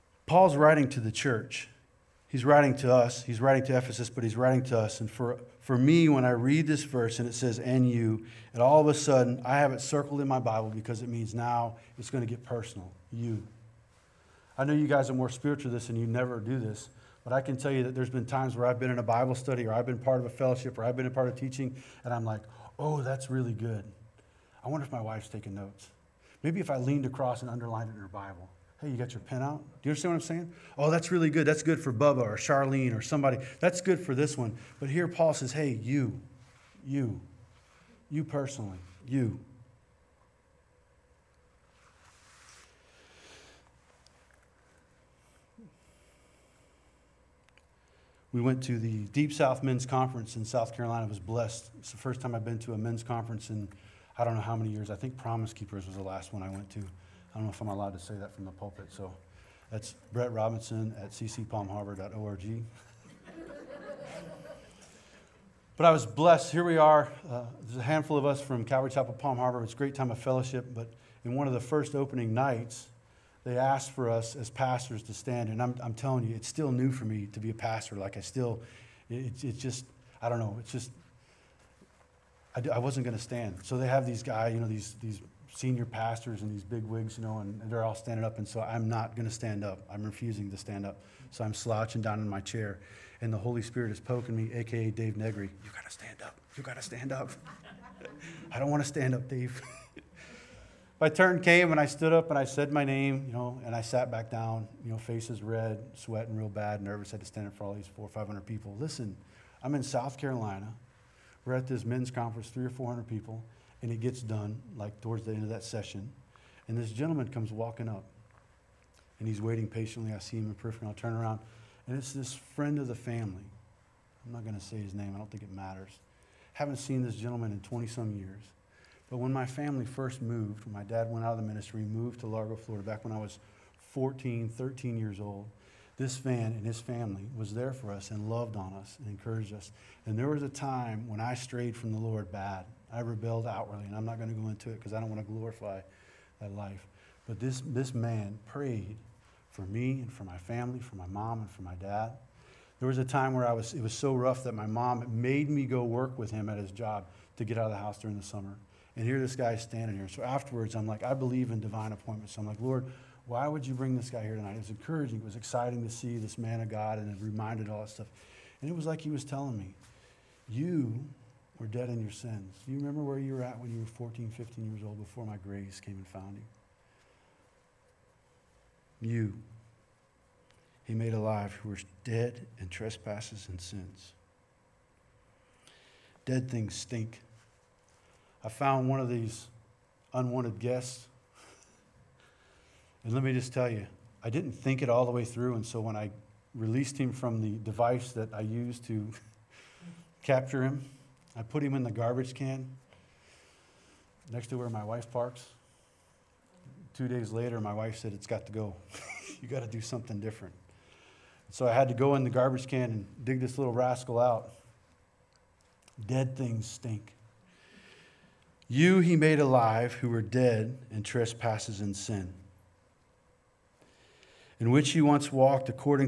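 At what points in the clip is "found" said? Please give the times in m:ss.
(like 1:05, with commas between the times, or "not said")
2:56, 3:08.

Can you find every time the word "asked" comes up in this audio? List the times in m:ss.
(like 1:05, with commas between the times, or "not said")
1:13.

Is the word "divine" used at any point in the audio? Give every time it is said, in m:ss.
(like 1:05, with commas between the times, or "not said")
2:41.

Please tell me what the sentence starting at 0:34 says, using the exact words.
But here Paul says, hey, you, you, you personally, you.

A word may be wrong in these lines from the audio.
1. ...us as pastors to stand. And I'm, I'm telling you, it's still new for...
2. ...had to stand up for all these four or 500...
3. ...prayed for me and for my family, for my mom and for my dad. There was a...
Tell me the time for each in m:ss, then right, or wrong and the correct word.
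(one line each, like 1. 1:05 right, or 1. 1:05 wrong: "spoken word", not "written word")
1. 1:14 right
2. 1:47 right
3. 2:28 right.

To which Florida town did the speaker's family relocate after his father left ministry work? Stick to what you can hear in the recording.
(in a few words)
Largo.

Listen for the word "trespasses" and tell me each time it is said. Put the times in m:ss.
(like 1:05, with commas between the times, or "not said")
3:02, 3:41.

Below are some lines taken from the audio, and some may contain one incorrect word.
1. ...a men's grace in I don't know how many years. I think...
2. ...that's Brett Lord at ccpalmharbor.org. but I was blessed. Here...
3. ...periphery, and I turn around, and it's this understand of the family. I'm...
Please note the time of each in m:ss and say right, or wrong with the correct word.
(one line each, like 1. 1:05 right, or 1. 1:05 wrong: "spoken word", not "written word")
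1. 0:52 wrong: "conference", not "grace"
2. 0:59 wrong: "Robinson", not "Lord"
3. 2:00 wrong: "friend", not "understand".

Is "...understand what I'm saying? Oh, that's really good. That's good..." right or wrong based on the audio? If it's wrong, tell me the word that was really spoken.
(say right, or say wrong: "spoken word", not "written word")
right.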